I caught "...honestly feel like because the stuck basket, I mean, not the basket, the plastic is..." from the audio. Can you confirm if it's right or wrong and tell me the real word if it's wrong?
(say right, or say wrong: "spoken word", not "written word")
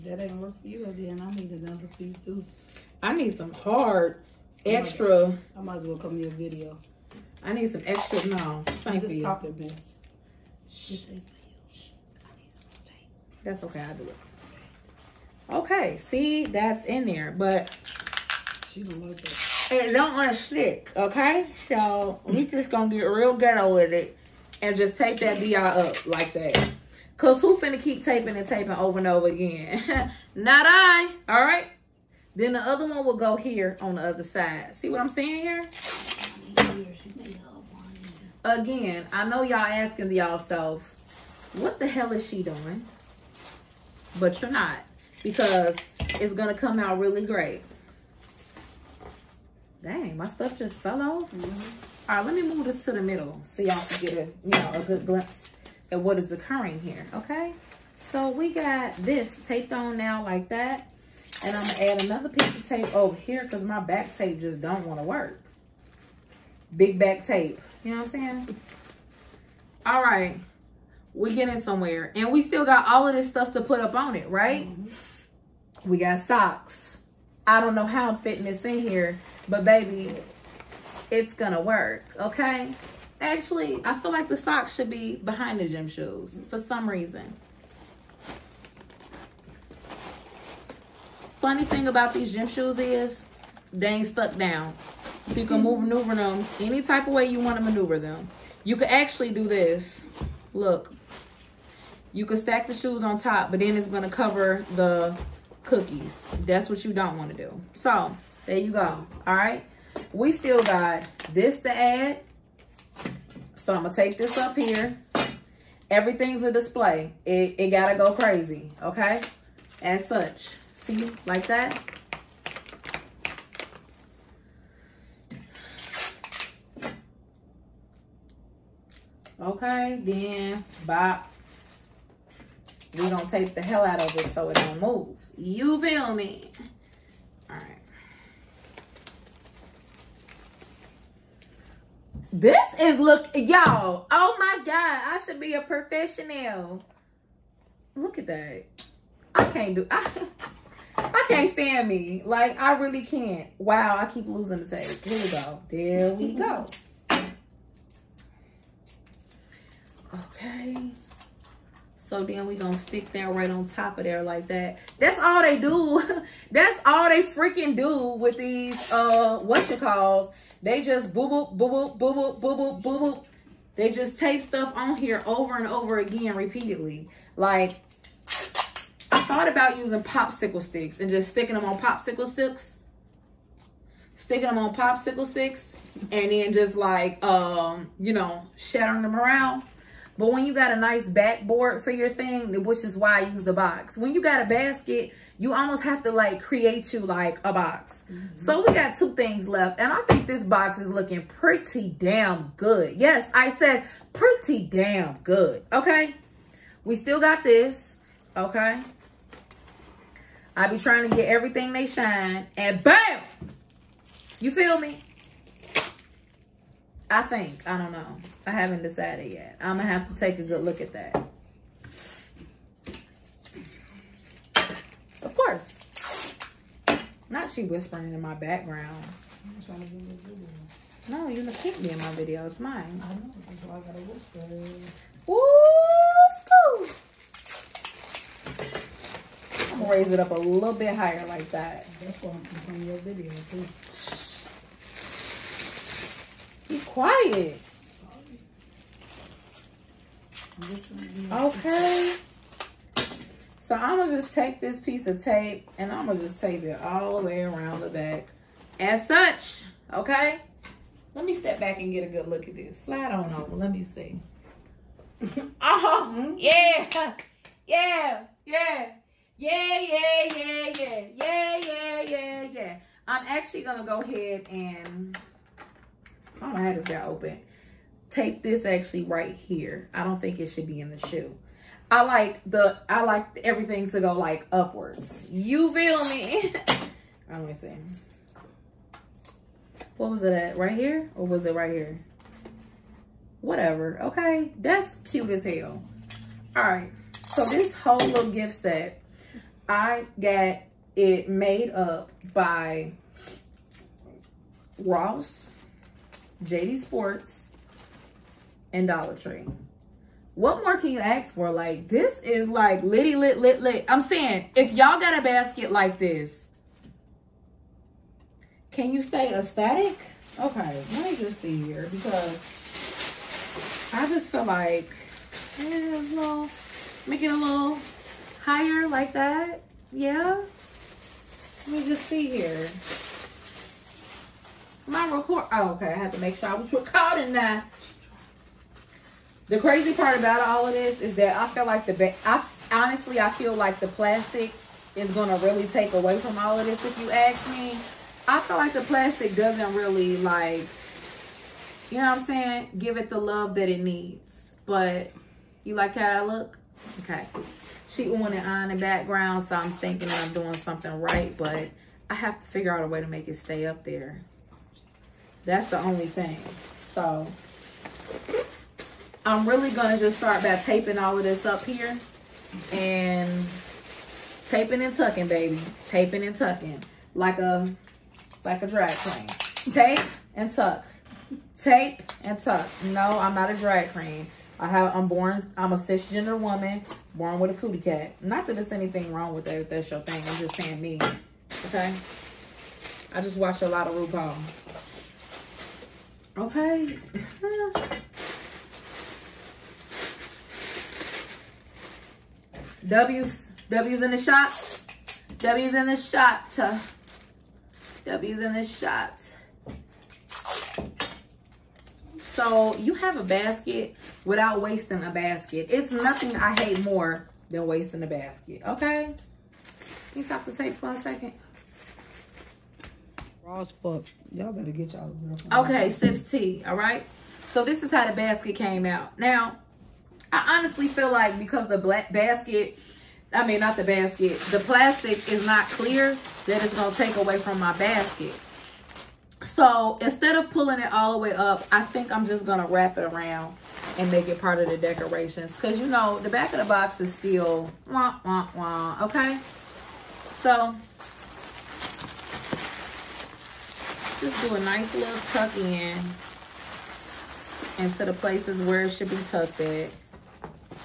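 wrong: "black", not "stuck".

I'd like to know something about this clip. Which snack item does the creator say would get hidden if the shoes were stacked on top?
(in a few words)
cookies.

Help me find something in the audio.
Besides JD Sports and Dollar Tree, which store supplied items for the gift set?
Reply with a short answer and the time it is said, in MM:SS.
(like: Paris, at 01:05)
Ross, at 05:04.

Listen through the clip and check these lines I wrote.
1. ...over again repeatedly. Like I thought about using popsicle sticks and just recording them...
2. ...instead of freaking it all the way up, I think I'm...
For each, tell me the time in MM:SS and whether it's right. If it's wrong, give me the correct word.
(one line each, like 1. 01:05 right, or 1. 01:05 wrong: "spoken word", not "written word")
1. 02:55 wrong: "sticking", not "recording"
2. 07:19 wrong: "pulling", not "freaking".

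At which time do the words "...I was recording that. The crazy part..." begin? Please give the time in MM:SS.
05:36.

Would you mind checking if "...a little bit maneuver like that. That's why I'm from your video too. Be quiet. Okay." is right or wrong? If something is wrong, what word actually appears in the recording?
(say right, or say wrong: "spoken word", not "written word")
wrong: "higher", not "maneuver".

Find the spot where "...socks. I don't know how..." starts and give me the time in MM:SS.
01:16.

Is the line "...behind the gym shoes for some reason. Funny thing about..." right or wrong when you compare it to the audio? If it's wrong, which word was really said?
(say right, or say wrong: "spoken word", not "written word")
right.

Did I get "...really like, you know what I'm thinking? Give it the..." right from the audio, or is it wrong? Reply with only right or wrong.
wrong.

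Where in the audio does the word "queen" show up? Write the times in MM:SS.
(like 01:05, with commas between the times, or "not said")
06:18, 06:23.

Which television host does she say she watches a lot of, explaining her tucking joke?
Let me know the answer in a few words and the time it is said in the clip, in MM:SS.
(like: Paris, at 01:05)
RuPaul, at 06:33.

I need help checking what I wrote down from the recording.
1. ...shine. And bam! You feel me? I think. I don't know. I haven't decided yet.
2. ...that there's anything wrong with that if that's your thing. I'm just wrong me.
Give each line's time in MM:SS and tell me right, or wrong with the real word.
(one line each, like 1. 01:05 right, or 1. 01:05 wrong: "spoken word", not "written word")
1. 03:31 right
2. 06:28 wrong: "saying", not "wrong".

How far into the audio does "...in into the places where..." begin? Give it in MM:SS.
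07:35.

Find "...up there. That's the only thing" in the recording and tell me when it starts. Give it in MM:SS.
06:03.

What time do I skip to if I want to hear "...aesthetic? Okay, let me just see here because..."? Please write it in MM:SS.
05:19.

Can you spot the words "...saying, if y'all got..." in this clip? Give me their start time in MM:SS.
05:14.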